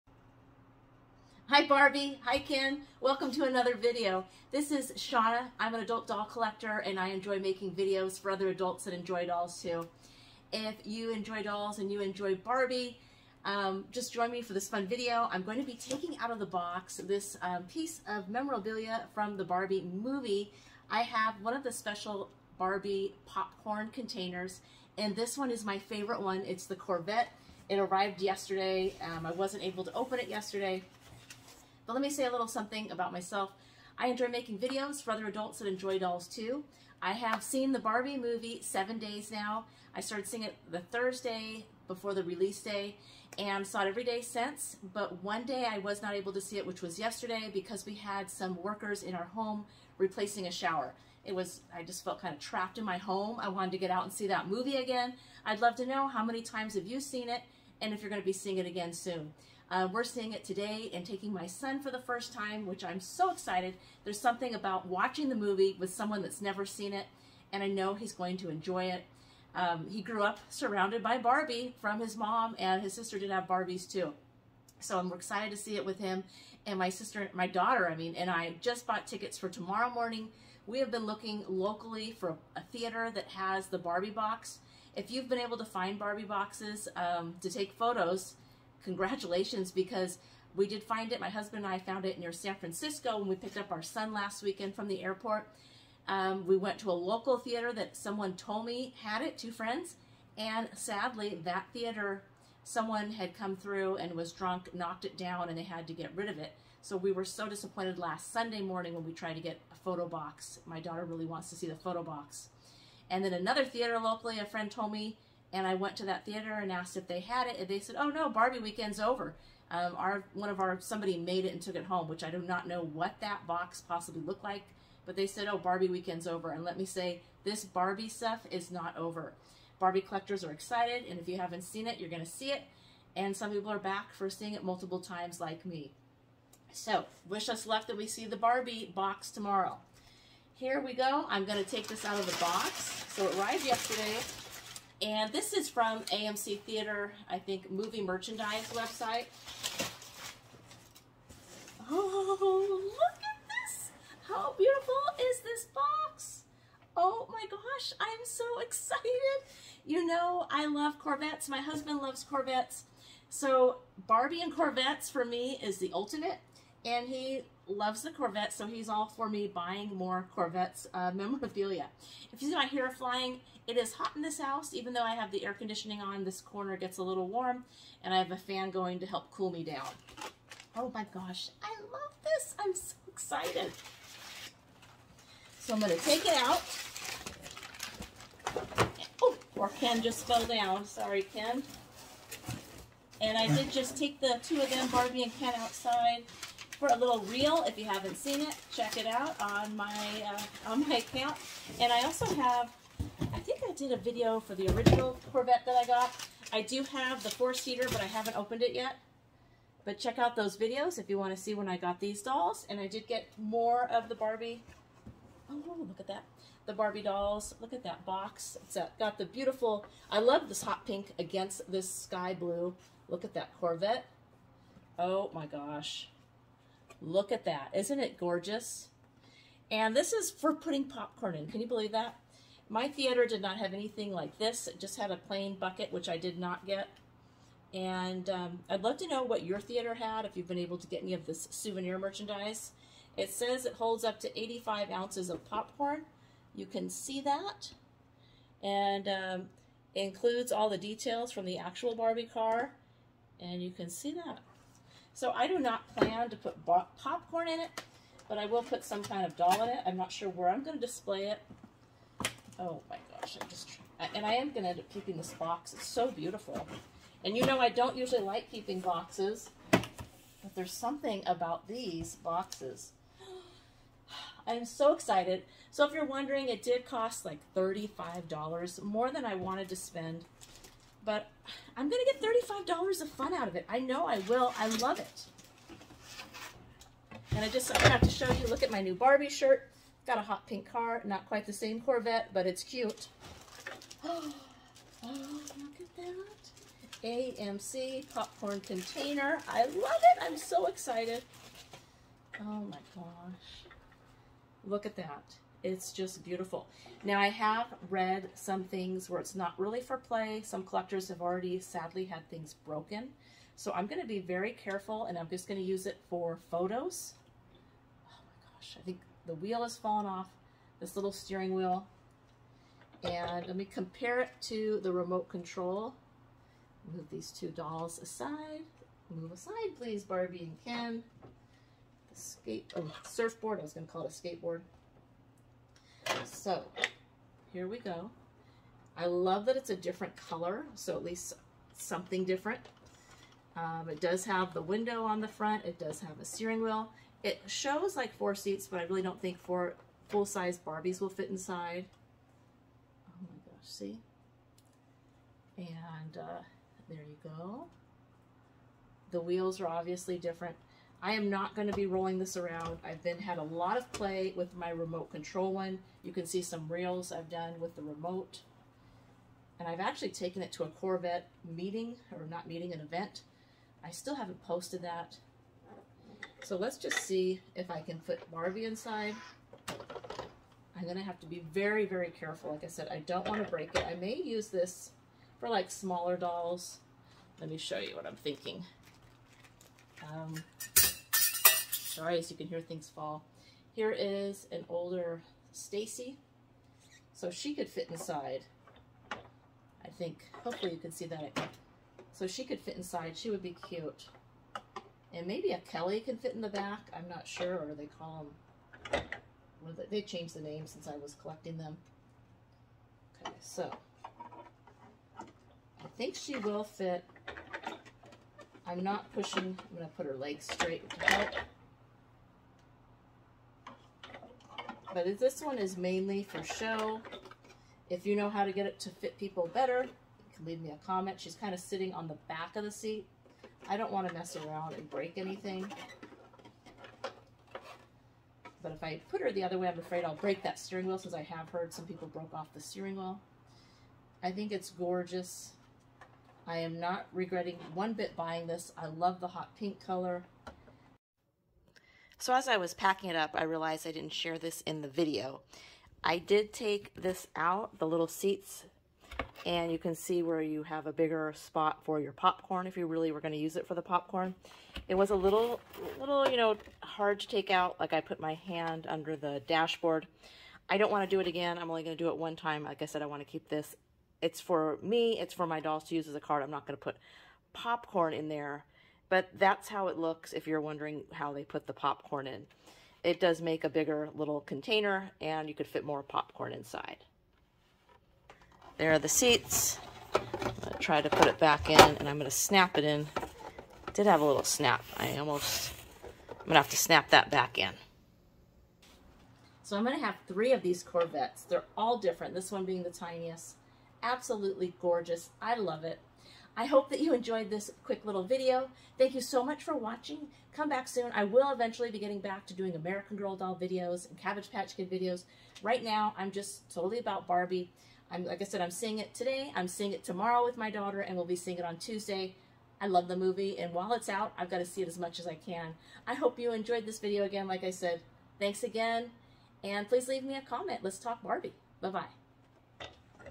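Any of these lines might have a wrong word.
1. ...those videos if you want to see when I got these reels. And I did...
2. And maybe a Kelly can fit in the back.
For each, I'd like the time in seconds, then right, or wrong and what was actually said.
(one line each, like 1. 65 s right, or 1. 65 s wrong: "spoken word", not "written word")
1. 210 s wrong: "dolls", not "reels"
2. 405 s right.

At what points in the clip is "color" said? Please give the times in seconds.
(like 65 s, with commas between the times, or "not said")
340 s, 449 s.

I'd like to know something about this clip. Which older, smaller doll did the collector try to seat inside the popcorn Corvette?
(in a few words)
Stacie.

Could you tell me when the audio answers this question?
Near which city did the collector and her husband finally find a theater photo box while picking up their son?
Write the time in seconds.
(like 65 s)
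92 s.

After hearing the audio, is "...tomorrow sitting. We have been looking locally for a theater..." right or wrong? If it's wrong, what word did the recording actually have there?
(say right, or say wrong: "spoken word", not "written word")
wrong: "morning", not "sitting".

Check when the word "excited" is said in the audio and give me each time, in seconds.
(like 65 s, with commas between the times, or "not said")
63 s, 75 s, 130 s, 158 s, 183 s, 274 s, 300 s.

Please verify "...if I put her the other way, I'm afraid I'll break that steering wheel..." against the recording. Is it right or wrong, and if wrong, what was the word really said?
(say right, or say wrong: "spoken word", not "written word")
right.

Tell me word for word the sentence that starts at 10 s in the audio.
If you enjoy dolls and you enjoy Barbie, um, just join me for this fun video.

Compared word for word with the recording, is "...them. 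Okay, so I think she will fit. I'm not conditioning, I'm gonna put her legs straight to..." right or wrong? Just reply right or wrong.
wrong.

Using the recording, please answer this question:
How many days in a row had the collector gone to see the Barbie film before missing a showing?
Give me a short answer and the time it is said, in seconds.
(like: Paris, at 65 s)
7, at 38 s.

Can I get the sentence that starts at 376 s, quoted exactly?
So let's just see if I can put Barbie inside.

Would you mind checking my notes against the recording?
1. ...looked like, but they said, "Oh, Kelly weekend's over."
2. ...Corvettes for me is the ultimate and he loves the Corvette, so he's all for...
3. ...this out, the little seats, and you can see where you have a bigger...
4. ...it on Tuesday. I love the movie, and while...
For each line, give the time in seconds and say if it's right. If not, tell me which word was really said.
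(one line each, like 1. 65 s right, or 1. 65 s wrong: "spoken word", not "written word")
1. 124 s wrong: "Barbie", not "Kelly"
2. 164 s right
3. 456 s right
4. 521 s right.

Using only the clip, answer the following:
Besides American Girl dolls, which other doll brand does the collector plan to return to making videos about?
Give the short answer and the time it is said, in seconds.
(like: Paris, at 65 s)
Cabbage Patch Kid, at 514 s.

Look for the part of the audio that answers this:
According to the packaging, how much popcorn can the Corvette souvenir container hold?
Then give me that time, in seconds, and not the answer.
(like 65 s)
244 s.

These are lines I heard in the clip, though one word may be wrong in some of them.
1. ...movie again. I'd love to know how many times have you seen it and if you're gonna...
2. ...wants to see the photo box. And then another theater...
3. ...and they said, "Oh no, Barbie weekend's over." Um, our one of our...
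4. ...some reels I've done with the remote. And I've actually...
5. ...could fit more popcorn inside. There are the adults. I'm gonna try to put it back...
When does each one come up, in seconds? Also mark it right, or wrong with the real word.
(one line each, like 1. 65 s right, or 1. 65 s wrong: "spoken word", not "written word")
1. 54 s right
2. 111 s right
3. 117 s right
4. 366 s right
5. 485 s wrong: "seats", not "adults".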